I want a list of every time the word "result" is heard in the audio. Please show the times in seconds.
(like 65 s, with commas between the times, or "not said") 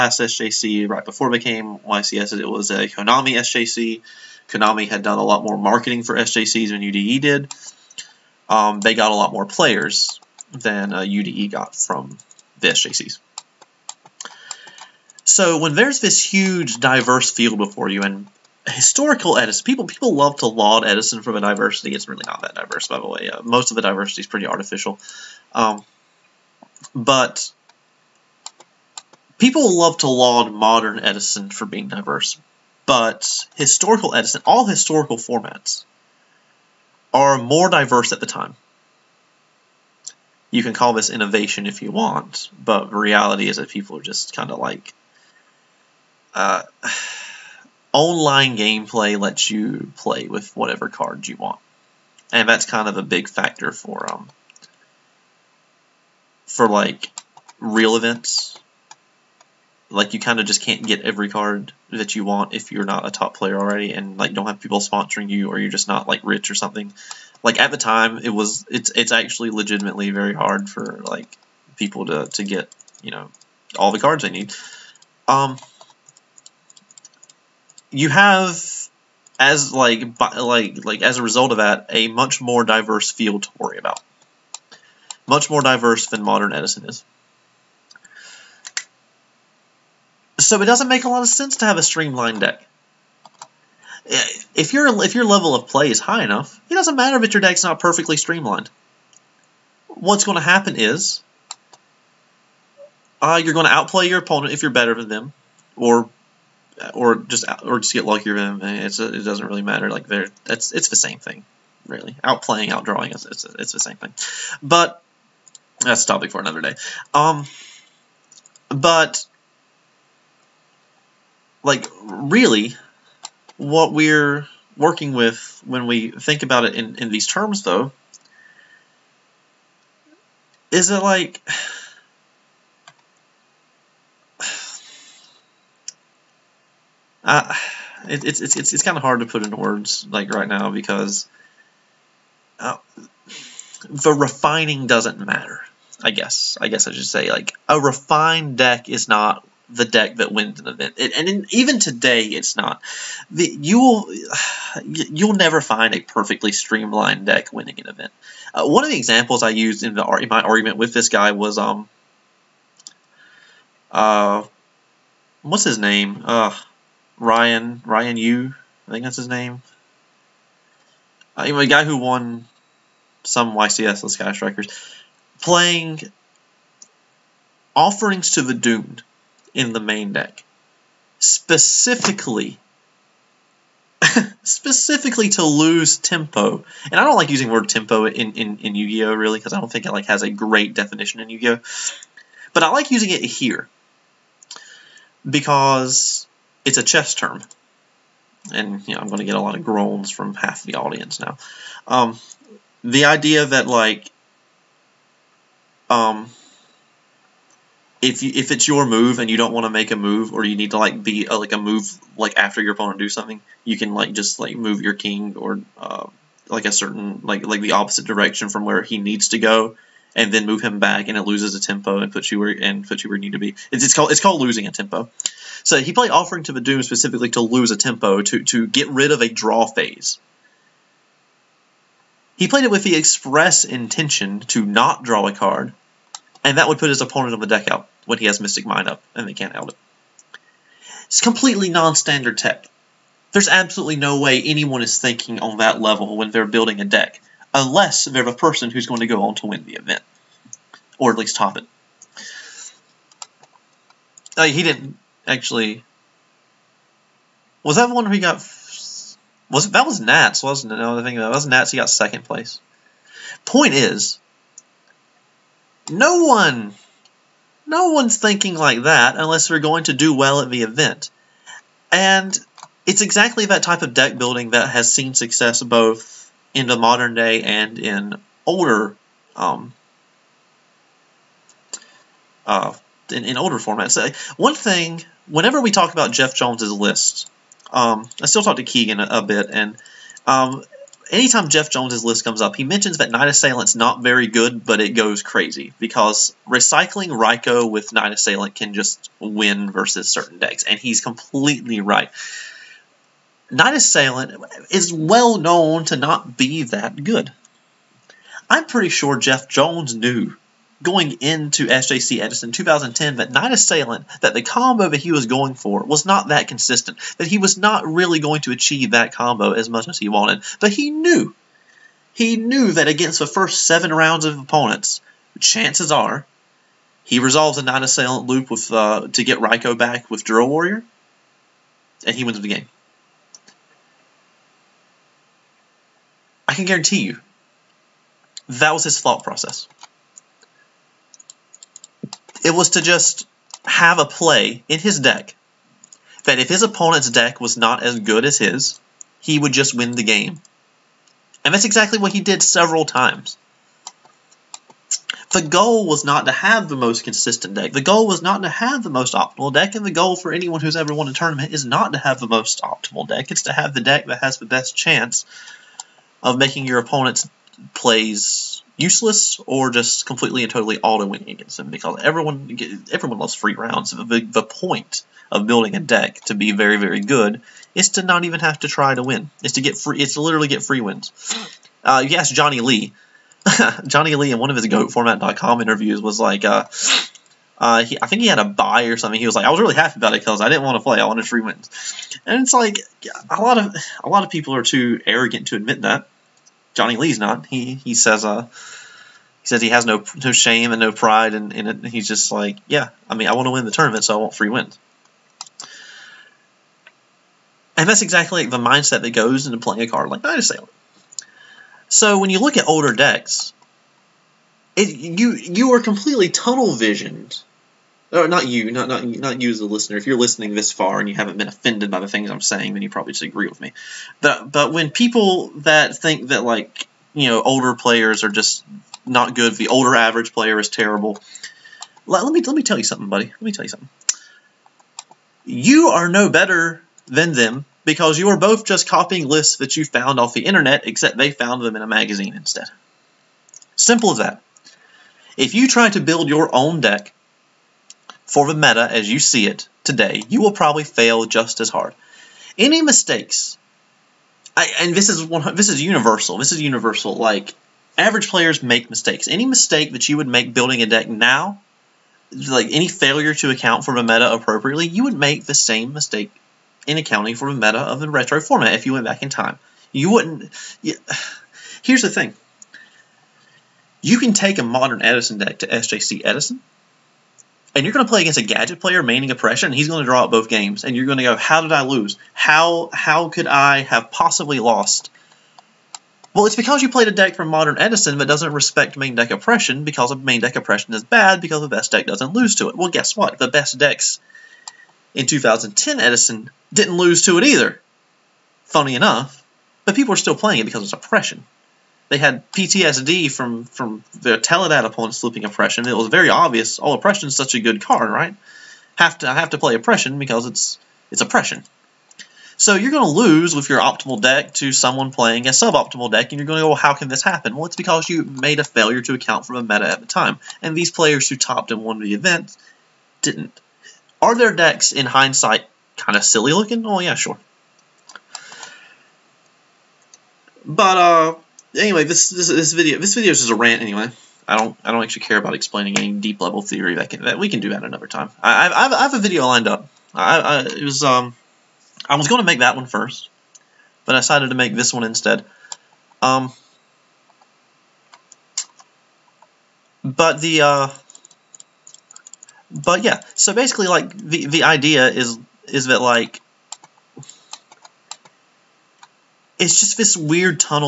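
81 s.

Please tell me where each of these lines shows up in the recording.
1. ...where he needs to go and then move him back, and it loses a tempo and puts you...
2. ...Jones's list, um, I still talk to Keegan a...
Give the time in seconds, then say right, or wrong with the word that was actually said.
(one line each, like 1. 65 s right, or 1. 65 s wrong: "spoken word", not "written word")
1. 218 s right
2. 286 s right.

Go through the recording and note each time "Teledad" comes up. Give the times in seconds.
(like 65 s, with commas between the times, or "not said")
504 s.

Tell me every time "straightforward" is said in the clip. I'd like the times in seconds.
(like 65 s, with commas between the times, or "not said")
not said.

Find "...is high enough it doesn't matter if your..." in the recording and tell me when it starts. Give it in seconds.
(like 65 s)
95 s.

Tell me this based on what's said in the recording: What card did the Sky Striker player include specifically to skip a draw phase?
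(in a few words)
Offerings to the Doomed.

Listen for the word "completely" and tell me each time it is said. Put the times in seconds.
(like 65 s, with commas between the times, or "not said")
241 s, 301 s, 370 s, 415 s.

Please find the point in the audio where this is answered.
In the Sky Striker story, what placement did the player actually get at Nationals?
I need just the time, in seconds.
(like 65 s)
261 s.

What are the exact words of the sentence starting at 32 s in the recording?
But historical Edison, all historical formats, are more diverse at the time.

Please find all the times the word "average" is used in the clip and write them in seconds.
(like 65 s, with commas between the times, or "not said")
429 s, 457 s.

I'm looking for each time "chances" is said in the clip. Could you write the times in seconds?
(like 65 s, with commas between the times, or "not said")
325 s, 364 s.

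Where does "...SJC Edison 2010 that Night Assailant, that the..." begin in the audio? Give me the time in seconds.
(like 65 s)
311 s.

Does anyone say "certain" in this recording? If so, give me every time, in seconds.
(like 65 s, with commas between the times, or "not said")
216 s, 300 s.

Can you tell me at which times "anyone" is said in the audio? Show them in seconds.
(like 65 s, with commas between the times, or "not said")
244 s, 360 s.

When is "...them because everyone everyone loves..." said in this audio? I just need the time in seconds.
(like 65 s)
371 s.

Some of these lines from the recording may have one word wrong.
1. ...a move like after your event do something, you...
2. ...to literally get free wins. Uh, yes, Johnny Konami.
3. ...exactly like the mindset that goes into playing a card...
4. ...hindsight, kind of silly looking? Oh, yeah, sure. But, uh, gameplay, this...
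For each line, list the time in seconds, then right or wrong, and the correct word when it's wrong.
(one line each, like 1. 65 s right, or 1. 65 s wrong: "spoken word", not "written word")
1. 211 s wrong: "opponent", not "event"
2. 380 s wrong: "Lee", not "Konami"
3. 408 s right
4. 525 s wrong: "anyway", not "gameplay".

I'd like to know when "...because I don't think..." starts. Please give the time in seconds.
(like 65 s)
189 s.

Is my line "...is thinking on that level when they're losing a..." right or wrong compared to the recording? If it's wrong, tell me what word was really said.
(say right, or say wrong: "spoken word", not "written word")
wrong: "building", not "losing".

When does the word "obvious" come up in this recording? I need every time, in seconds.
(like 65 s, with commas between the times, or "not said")
506 s.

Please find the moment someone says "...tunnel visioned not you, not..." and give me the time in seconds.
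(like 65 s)
416 s.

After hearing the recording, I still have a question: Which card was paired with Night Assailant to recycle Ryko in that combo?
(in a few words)
Drill Warrior.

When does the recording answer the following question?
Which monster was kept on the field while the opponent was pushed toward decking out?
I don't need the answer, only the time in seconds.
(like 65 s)
238 s.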